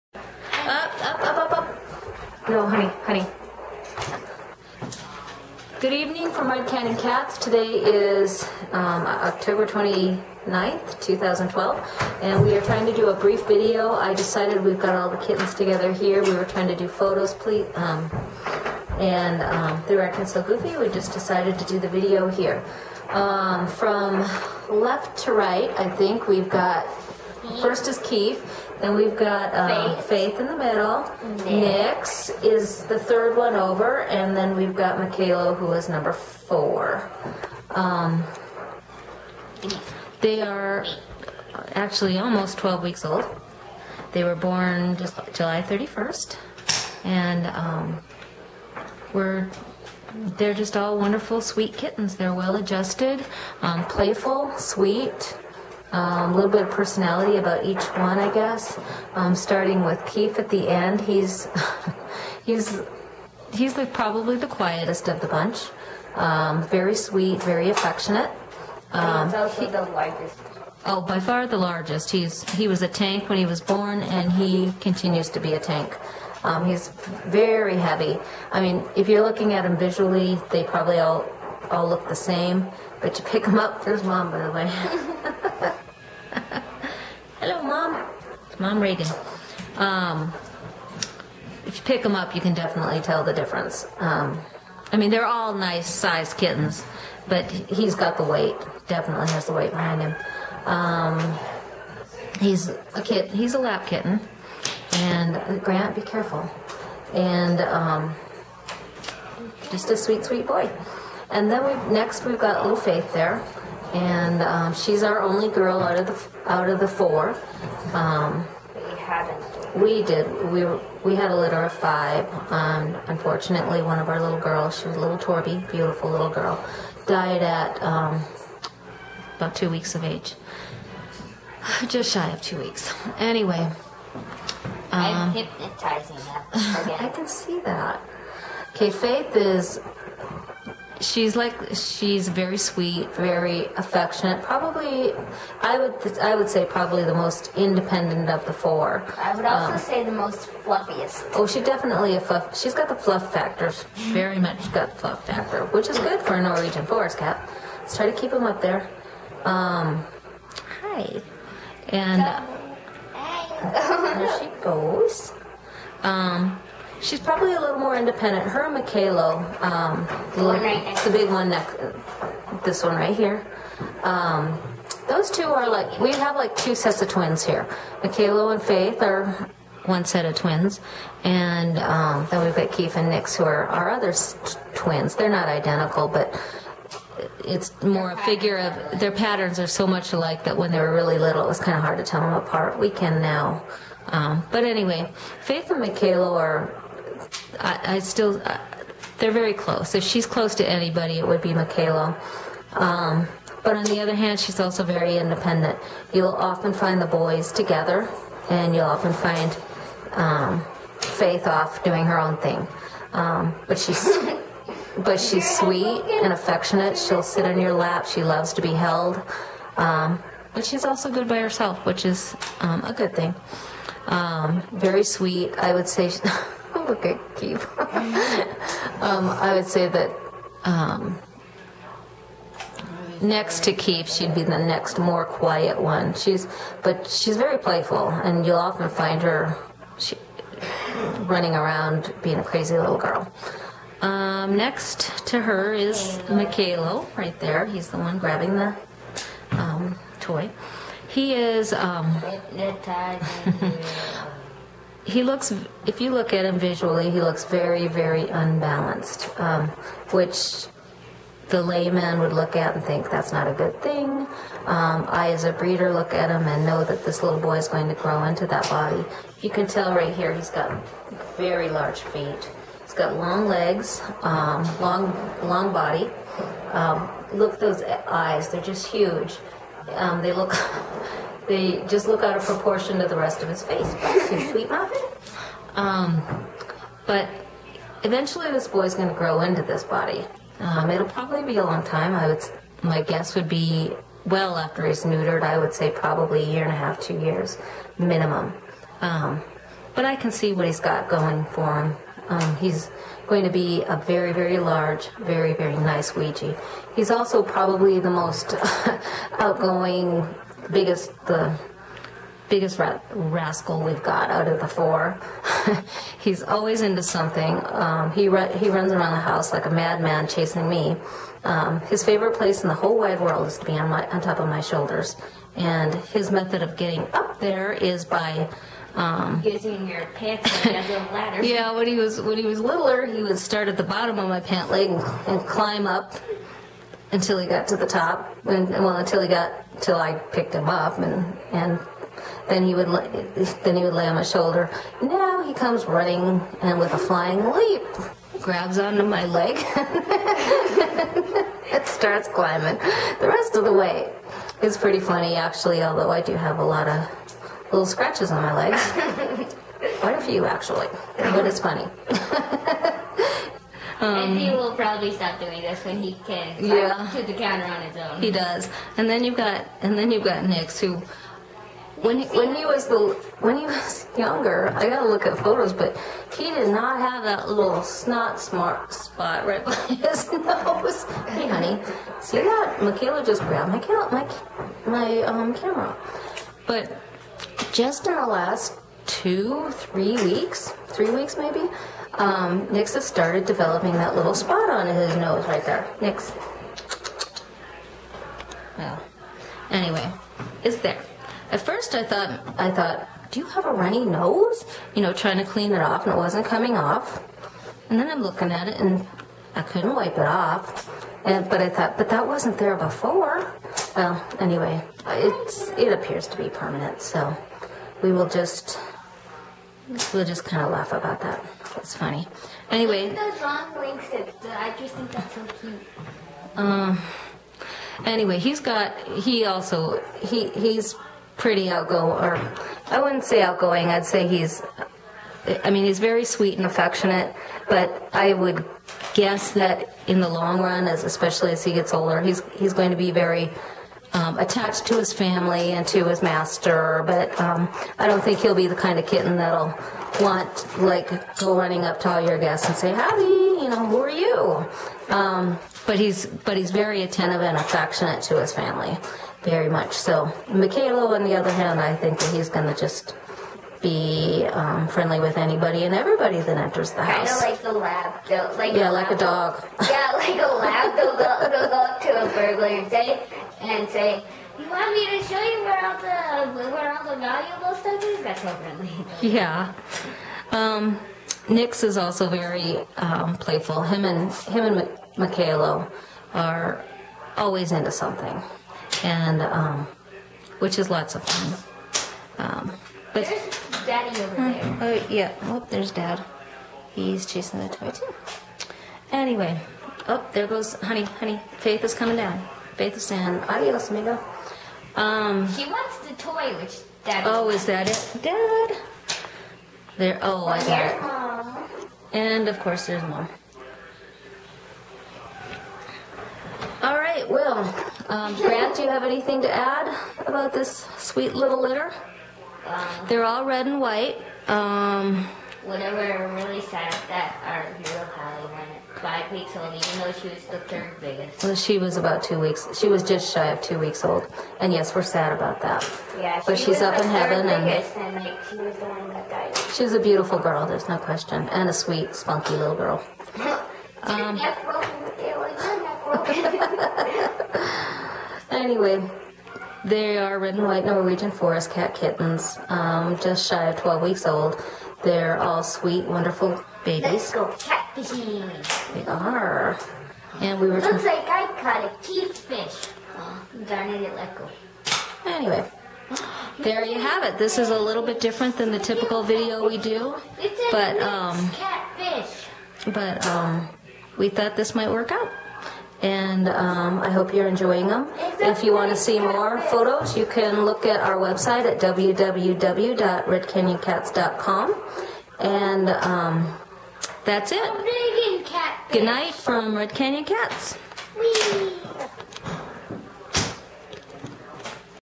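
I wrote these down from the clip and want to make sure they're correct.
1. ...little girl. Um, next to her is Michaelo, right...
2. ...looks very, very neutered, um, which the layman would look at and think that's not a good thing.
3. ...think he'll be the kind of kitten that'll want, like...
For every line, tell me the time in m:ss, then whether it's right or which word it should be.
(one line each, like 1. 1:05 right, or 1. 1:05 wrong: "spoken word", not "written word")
1. 4:02 right
2. 4:17 wrong: "unbalanced", not "neutered"
3. 7:28 right.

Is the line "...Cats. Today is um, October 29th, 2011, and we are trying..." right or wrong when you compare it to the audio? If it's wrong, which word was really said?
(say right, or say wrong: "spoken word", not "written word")
wrong: "2012", not "2011".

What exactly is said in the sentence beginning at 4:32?
He's got long legs, um, long, long body.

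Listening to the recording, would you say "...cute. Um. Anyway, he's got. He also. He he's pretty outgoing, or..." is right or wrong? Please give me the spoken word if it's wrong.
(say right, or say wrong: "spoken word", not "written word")
right.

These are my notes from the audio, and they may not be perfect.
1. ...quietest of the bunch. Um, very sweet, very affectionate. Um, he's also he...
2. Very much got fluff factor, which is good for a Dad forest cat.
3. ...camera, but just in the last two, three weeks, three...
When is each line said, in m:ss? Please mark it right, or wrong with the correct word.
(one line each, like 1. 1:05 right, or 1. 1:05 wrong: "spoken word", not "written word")
1. 1:04 right
2. 2:33 wrong: "Norwegian", not "Dad"
3. 6:25 right.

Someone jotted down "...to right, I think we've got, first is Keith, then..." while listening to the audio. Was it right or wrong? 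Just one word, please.
right.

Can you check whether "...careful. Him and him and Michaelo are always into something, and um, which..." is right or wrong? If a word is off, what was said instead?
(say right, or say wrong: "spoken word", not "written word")
wrong: "playful", not "careful".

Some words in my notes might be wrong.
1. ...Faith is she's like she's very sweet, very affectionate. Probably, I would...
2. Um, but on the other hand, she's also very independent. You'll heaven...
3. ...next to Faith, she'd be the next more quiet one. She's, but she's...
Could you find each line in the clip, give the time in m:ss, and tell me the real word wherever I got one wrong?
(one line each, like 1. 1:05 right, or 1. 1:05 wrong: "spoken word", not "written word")
1. 2:18 right
2. 3:22 wrong: "often", not "heaven"
3. 3:53 wrong: "Keep", not "Faith".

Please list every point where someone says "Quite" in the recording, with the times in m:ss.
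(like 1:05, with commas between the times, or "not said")
5:59.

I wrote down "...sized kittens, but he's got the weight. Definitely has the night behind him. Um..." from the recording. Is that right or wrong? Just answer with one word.
wrong.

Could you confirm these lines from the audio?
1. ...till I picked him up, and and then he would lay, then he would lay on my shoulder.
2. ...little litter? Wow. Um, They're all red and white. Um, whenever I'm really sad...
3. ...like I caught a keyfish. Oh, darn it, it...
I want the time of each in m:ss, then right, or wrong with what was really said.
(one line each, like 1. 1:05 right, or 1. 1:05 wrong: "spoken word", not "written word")
1. 5:39 right
2. 8:41 right
3. 9:21 right.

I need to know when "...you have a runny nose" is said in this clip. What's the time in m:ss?
6:43.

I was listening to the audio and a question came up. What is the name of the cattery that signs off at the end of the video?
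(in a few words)
Red Canyon Cats.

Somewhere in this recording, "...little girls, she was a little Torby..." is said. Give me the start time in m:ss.
2:04.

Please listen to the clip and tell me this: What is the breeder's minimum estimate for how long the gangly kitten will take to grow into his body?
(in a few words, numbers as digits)
a year and a half.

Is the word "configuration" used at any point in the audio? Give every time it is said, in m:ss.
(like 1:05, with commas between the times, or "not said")
not said.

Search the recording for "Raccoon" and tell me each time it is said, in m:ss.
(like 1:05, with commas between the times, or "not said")
0:19.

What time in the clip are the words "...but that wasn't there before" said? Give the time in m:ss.
6:51.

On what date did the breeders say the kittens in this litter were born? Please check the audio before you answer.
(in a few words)
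July 31.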